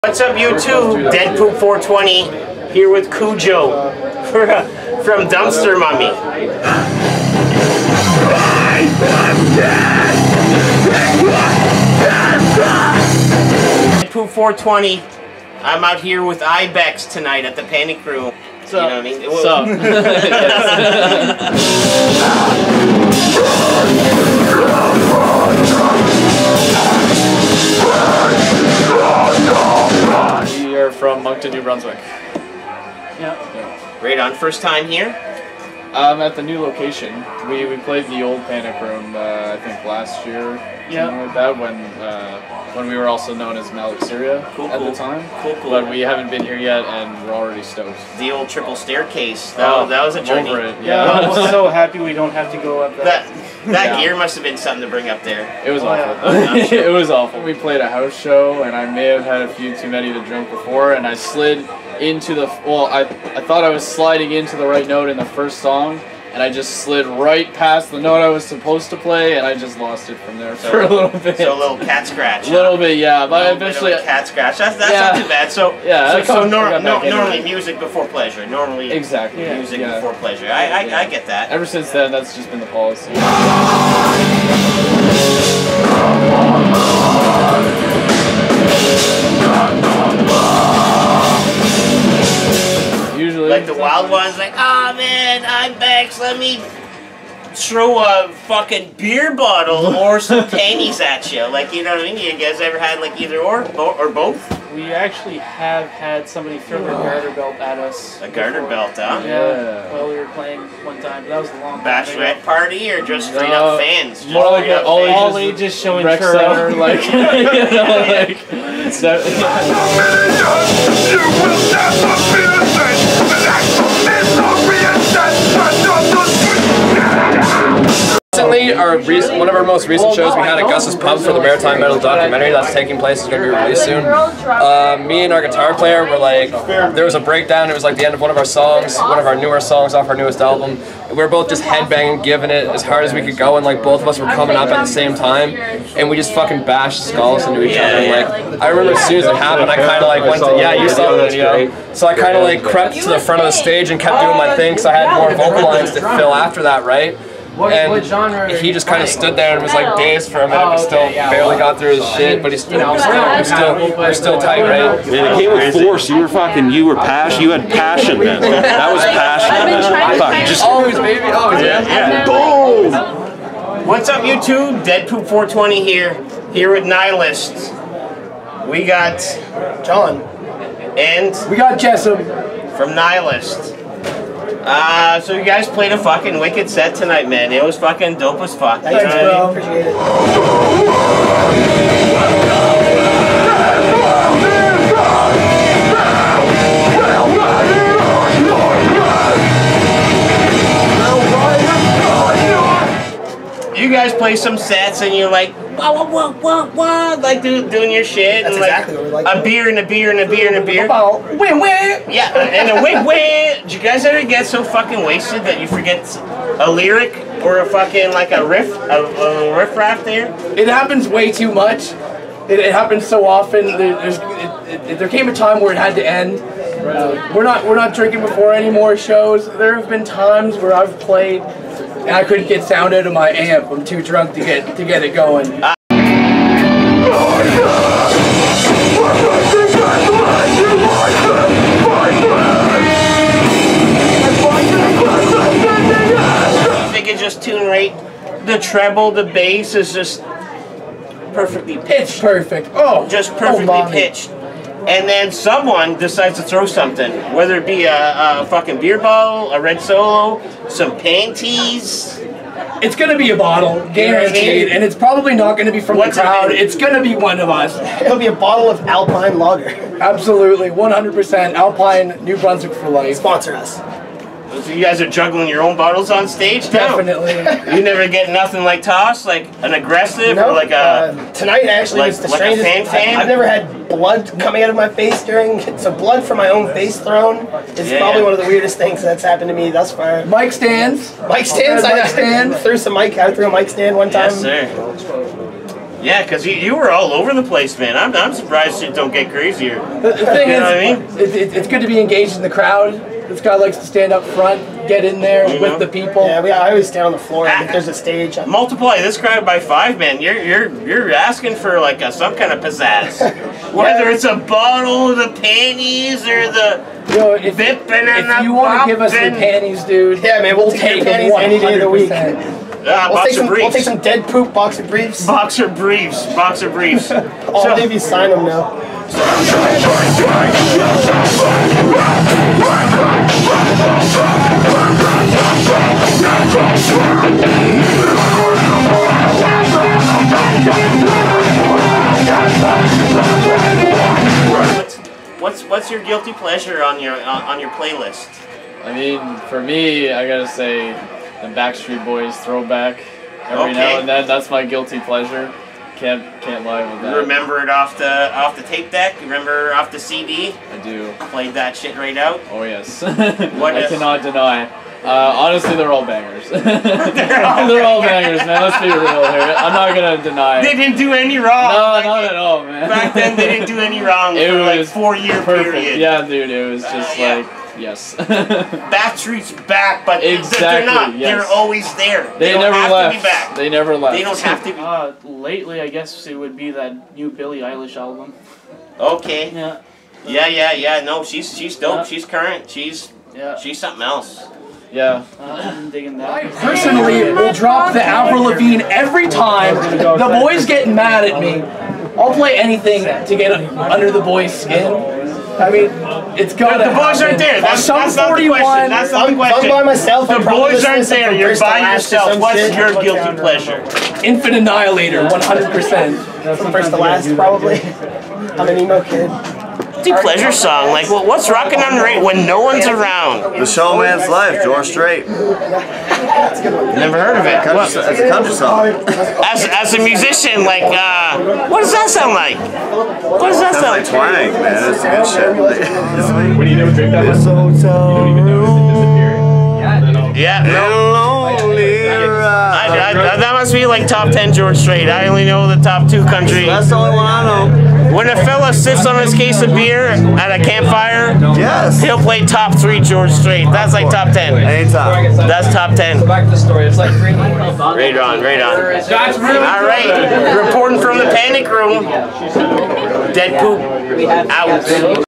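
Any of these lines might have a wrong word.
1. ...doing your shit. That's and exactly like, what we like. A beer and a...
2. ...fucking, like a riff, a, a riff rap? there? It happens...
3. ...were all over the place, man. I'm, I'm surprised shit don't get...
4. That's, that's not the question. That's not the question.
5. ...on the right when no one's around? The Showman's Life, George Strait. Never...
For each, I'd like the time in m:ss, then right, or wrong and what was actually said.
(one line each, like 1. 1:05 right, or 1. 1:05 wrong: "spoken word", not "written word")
1. 3:27 right
2. 3:37 right
3. 4:56 right
4. 6:47 right
5. 7:01 right.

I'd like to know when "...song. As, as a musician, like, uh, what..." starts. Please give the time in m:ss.
7:08.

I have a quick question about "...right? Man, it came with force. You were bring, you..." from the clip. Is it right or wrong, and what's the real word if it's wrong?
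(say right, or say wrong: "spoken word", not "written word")
wrong: "fucking", not "bring".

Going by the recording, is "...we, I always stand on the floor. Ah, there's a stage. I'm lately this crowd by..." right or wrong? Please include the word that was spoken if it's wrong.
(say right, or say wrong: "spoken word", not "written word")
wrong: "multiply", not "lately".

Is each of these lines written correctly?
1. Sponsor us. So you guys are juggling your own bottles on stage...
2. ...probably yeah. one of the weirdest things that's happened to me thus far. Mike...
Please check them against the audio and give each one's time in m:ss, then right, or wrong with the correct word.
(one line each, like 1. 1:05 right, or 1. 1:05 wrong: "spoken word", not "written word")
1. 4:33 right
2. 4:47 right.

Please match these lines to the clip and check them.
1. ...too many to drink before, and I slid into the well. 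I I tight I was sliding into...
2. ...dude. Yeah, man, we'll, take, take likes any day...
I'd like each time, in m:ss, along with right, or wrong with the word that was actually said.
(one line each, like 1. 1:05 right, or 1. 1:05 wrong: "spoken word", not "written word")
1. 0:59 wrong: "thought", not "tight"
2. 5:19 wrong: "panties", not "likes".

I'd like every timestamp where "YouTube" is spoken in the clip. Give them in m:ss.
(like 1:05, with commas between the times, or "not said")
0:00, 2:54.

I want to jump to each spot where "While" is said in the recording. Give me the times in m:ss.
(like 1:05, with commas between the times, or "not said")
1:49.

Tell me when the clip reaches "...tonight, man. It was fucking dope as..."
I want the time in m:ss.
3:06.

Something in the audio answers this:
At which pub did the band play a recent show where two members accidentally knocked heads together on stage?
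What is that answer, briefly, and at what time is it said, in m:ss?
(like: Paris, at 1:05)
Gus's Pub, at 2:10.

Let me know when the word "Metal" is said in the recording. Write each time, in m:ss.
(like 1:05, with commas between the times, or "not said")
2:11.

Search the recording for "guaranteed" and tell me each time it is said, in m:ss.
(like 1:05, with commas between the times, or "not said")
4:23.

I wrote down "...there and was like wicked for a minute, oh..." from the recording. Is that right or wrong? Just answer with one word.
wrong.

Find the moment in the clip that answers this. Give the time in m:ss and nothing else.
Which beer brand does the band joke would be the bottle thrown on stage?
4:28.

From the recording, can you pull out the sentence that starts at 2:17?
It was like the end of one of our songs, one of our newer songs off our newest album.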